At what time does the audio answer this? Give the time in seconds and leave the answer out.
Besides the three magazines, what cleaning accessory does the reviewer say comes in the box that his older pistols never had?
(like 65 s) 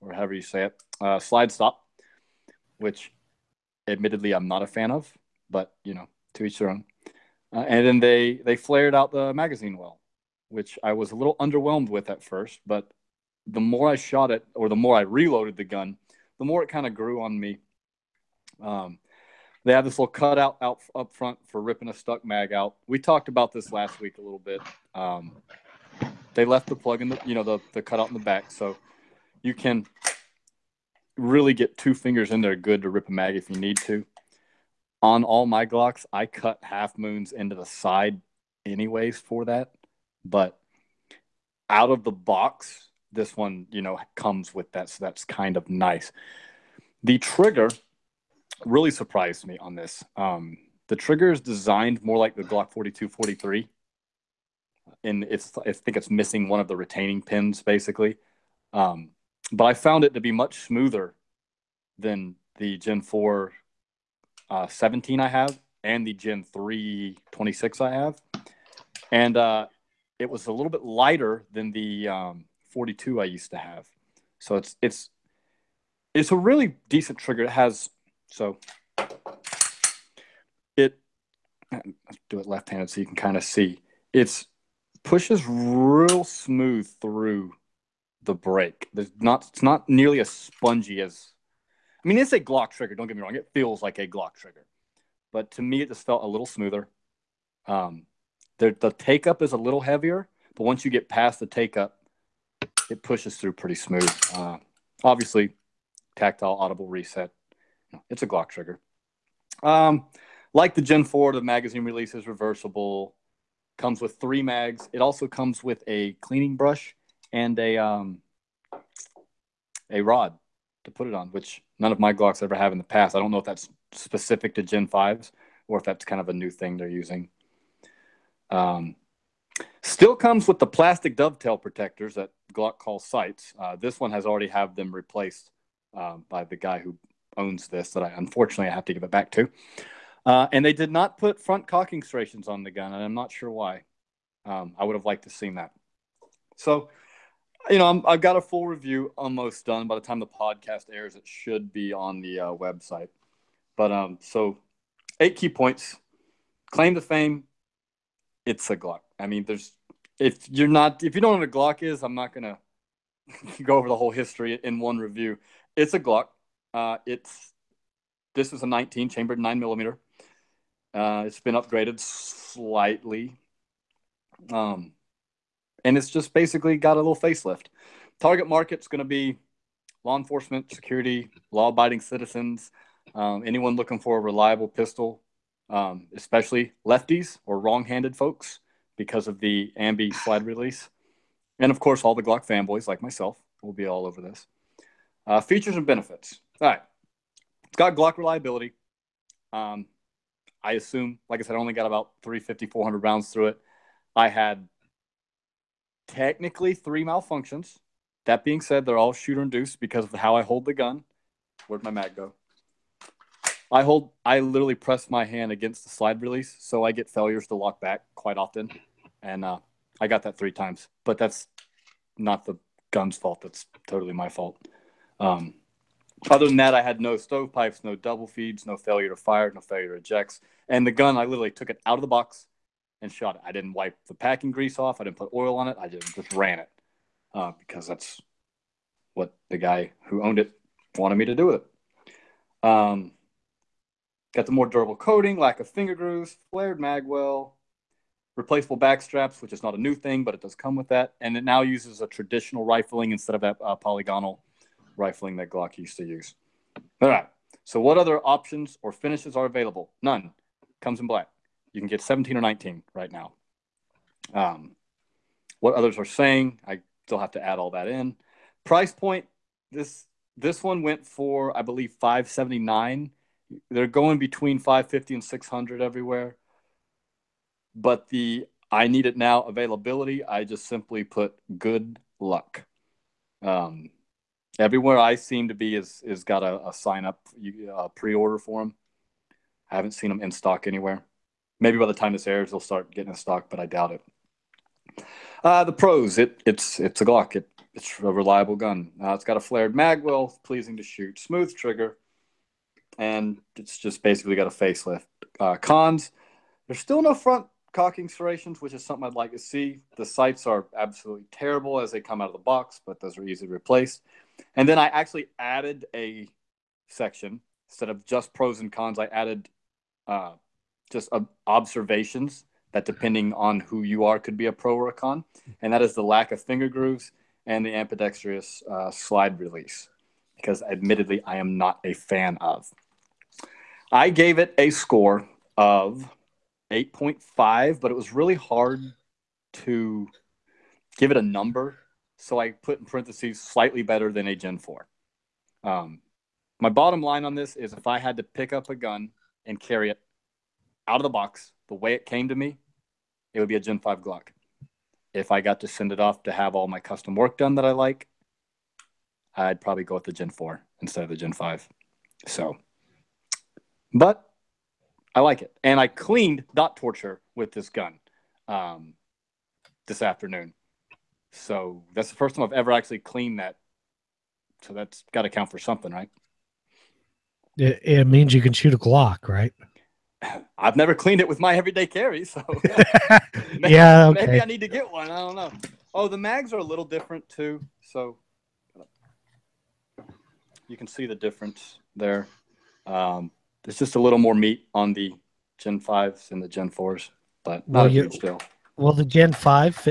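116 s.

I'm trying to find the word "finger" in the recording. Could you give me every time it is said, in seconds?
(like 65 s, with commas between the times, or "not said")
31 s, 245 s, 326 s.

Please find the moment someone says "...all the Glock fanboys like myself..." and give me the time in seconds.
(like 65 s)
192 s.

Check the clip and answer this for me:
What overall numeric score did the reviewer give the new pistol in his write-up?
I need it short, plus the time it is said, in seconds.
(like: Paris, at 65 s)
8.5, at 336 s.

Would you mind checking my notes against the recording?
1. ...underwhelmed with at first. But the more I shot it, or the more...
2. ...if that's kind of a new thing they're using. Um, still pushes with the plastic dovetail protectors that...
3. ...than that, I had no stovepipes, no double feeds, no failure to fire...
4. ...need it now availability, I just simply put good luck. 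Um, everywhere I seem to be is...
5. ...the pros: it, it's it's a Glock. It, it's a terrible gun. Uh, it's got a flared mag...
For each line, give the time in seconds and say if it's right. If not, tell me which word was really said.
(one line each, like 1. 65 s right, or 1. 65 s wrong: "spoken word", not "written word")
1. 11 s right
2. 125 s wrong: "comes", not "pushes"
3. 226 s right
4. 278 s right
5. 295 s wrong: "reliable", not "terrible".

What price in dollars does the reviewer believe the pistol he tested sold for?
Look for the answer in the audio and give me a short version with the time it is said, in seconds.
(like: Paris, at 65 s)
$579, at 271 s.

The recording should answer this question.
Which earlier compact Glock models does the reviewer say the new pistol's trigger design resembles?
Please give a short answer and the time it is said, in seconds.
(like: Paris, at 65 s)
Glock 42/43, at 52 s.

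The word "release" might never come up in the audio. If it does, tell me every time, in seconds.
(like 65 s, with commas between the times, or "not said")
111 s, 190 s, 216 s, 329 s.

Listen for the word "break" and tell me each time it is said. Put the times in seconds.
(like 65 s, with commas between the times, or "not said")
88 s.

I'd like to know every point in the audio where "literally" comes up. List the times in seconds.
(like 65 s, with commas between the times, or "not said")
214 s, 231 s.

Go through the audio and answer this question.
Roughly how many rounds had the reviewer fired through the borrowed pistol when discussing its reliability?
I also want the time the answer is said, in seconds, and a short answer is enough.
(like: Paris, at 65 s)
350-400, at 202 s.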